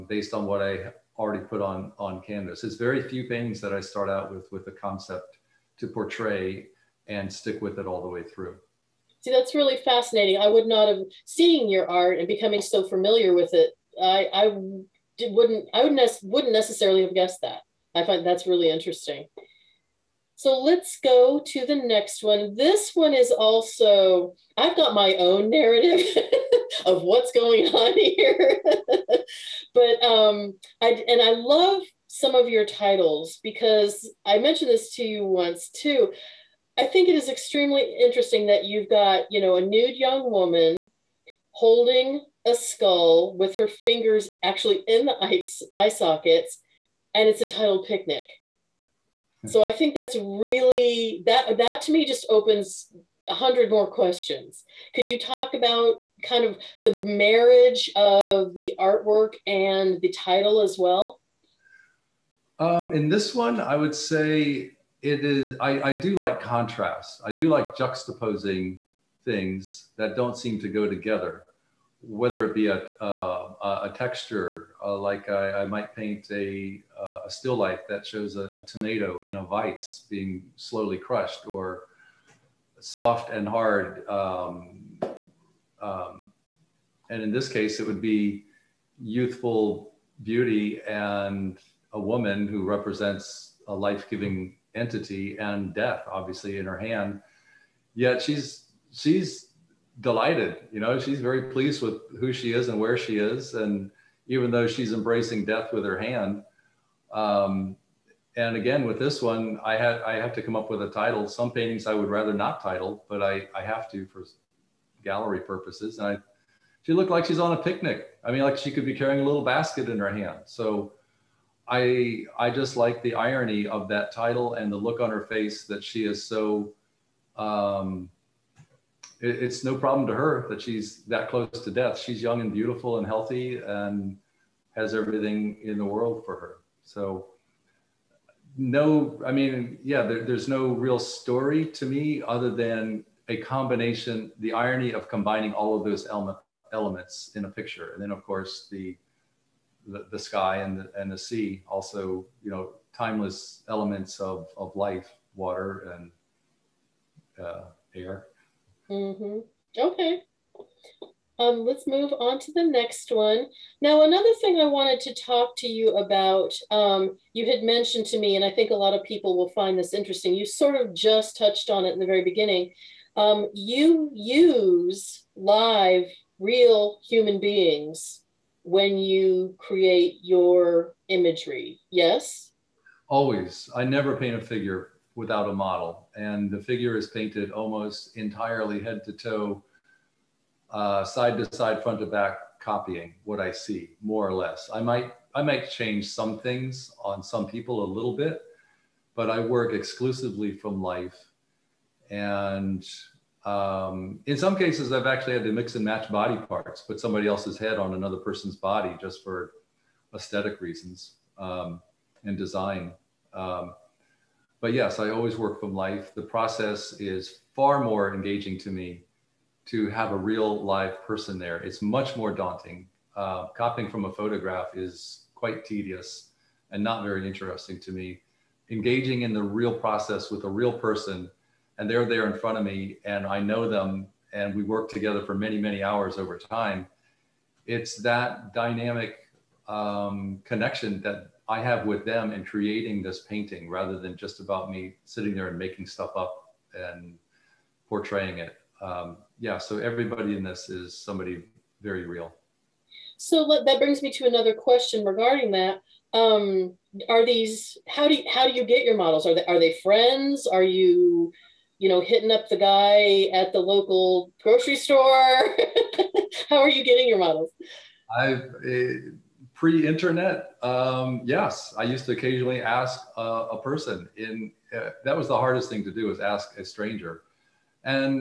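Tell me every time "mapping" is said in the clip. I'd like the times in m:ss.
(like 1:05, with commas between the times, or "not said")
not said.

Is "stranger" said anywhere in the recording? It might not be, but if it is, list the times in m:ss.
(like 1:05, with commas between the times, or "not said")
4:36.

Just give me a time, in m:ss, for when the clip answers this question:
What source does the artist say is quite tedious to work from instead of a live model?
3:44.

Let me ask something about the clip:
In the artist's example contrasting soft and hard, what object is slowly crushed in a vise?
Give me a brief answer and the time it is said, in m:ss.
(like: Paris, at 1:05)
A tomato, at 1:18.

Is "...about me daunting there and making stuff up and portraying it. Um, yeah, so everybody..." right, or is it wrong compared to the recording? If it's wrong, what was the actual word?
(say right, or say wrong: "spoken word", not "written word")
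wrong: "sitting", not "daunting".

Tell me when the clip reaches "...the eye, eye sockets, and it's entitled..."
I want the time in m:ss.
0:45.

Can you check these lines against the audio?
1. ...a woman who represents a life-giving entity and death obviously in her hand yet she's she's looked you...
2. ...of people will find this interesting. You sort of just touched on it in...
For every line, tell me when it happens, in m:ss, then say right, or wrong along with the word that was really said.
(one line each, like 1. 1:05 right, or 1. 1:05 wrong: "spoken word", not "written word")
1. 1:31 wrong: "delighted", not "looked"
2. 2:48 right.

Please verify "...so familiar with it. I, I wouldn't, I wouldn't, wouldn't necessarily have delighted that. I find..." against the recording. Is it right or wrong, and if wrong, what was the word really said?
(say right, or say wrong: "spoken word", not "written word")
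wrong: "guessed", not "delighted".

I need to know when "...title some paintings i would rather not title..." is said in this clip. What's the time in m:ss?
1:50.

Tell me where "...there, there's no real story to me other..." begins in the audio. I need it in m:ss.
2:20.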